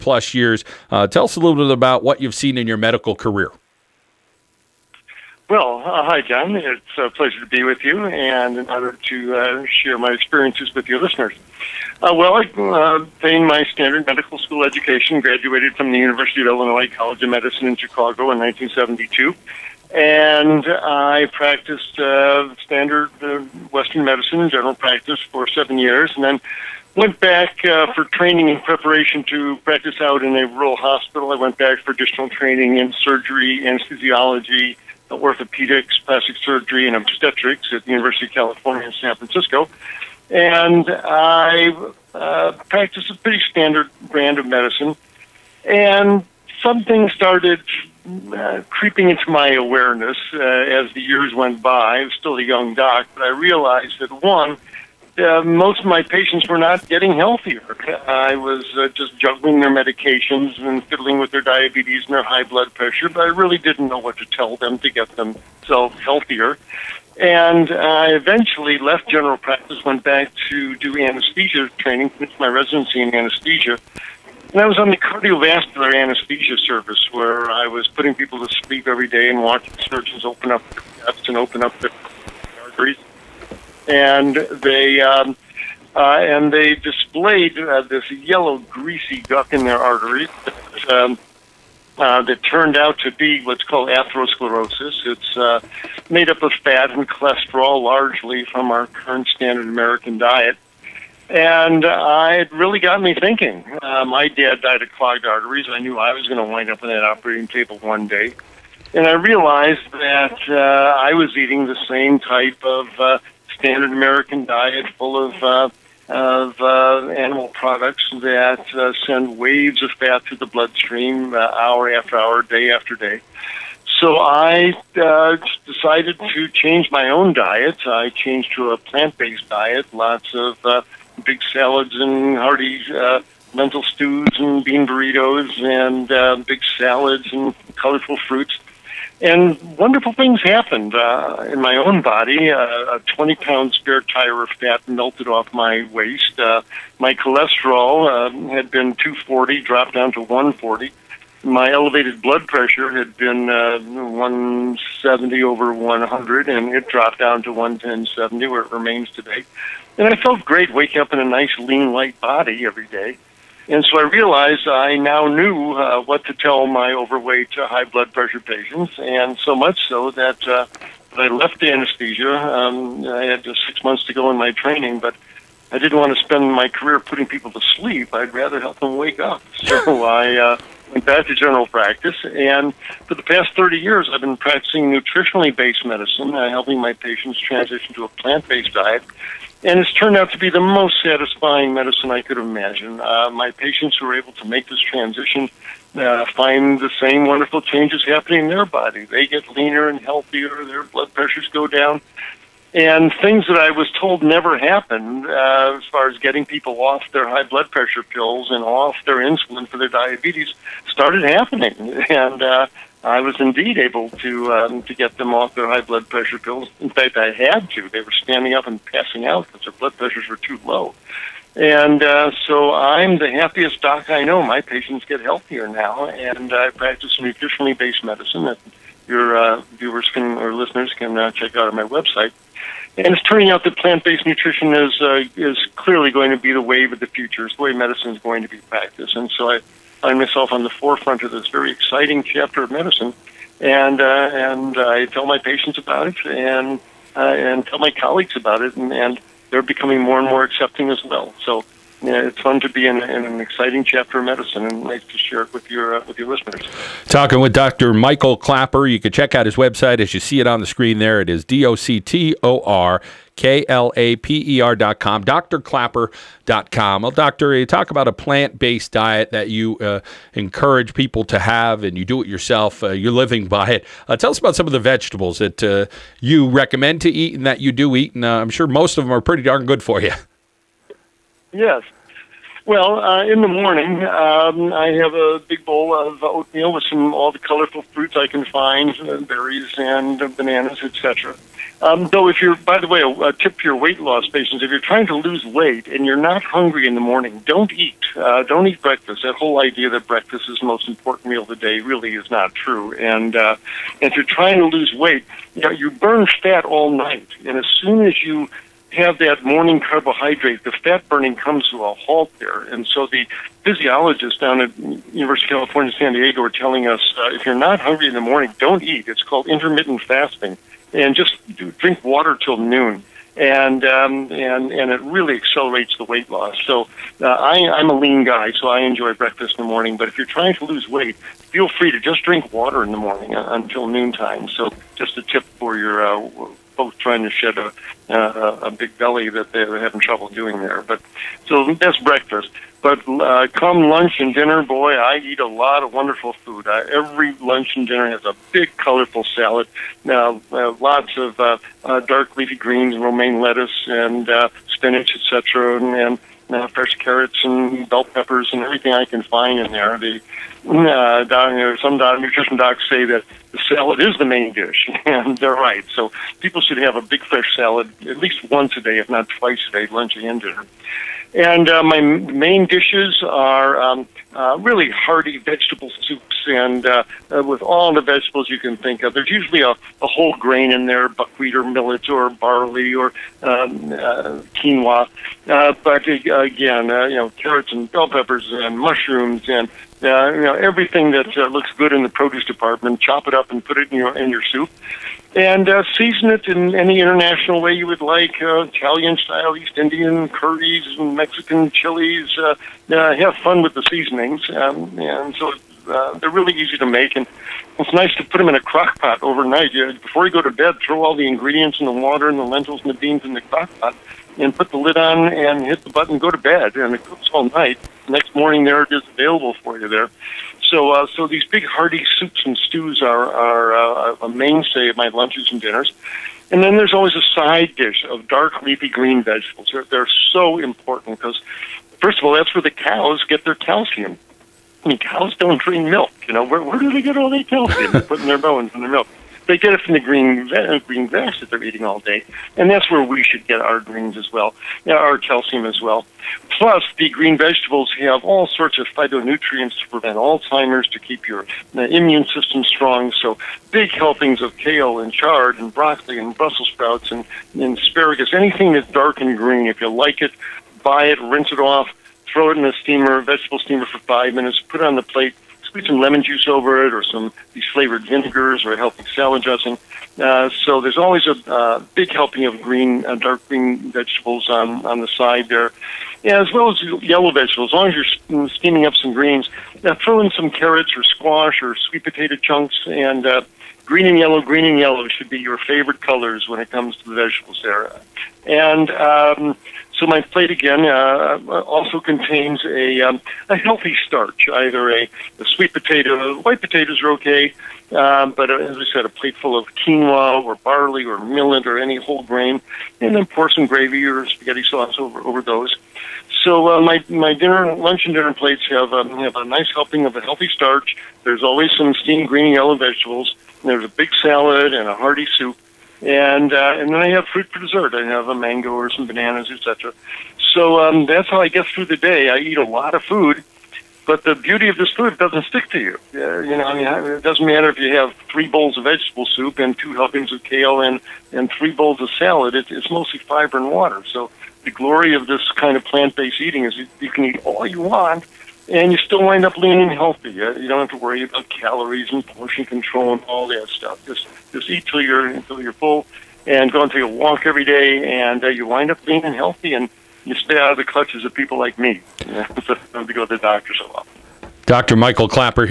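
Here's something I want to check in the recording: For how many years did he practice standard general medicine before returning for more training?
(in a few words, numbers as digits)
7.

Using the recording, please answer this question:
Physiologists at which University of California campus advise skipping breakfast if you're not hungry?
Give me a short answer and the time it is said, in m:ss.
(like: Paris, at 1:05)
San Diego, at 5:15.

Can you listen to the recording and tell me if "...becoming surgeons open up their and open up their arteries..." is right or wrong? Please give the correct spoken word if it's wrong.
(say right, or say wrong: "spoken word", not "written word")
wrong: "watching", not "becoming".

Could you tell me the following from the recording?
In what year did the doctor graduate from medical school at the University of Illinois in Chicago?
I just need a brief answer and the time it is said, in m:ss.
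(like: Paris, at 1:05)
1972, at 0:18.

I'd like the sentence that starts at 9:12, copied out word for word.
You know, so I don't have to go to the doctor so often.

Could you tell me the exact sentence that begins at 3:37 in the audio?
They were standing up and passing out because their blood pressures were too low.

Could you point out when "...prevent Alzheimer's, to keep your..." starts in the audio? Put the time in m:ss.
7:29.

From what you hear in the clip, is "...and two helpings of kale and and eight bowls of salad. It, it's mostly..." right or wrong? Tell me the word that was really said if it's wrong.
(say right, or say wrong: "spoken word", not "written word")
wrong: "three", not "eight".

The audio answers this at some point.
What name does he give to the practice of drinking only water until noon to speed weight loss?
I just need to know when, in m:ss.
5:19.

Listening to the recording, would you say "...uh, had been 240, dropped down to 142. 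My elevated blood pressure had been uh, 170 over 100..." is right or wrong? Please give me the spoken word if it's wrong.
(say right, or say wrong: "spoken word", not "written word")
wrong: "140", not "142".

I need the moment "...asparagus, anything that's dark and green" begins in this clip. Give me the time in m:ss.
7:37.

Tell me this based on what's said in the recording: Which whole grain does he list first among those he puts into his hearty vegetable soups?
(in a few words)
Buckwheat.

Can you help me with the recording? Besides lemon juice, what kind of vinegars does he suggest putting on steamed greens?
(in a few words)
Flavored vinegars.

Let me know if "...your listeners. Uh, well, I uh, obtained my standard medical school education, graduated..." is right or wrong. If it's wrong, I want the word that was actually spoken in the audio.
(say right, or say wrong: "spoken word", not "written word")
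right.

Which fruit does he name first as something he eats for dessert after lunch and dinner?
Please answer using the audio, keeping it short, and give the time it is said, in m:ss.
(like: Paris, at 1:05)
Mango, at 8:38.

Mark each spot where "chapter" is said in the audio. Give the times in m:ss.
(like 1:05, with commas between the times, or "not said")
4:02, 4:13.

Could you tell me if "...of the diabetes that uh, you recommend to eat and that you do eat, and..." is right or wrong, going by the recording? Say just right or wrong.
wrong.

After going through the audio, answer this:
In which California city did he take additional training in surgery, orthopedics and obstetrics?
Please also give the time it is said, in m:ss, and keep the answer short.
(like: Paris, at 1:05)
San Francisco, at 0:38.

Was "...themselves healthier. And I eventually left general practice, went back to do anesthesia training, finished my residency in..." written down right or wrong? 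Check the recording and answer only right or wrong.
right.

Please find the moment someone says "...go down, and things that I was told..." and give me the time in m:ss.
3:21.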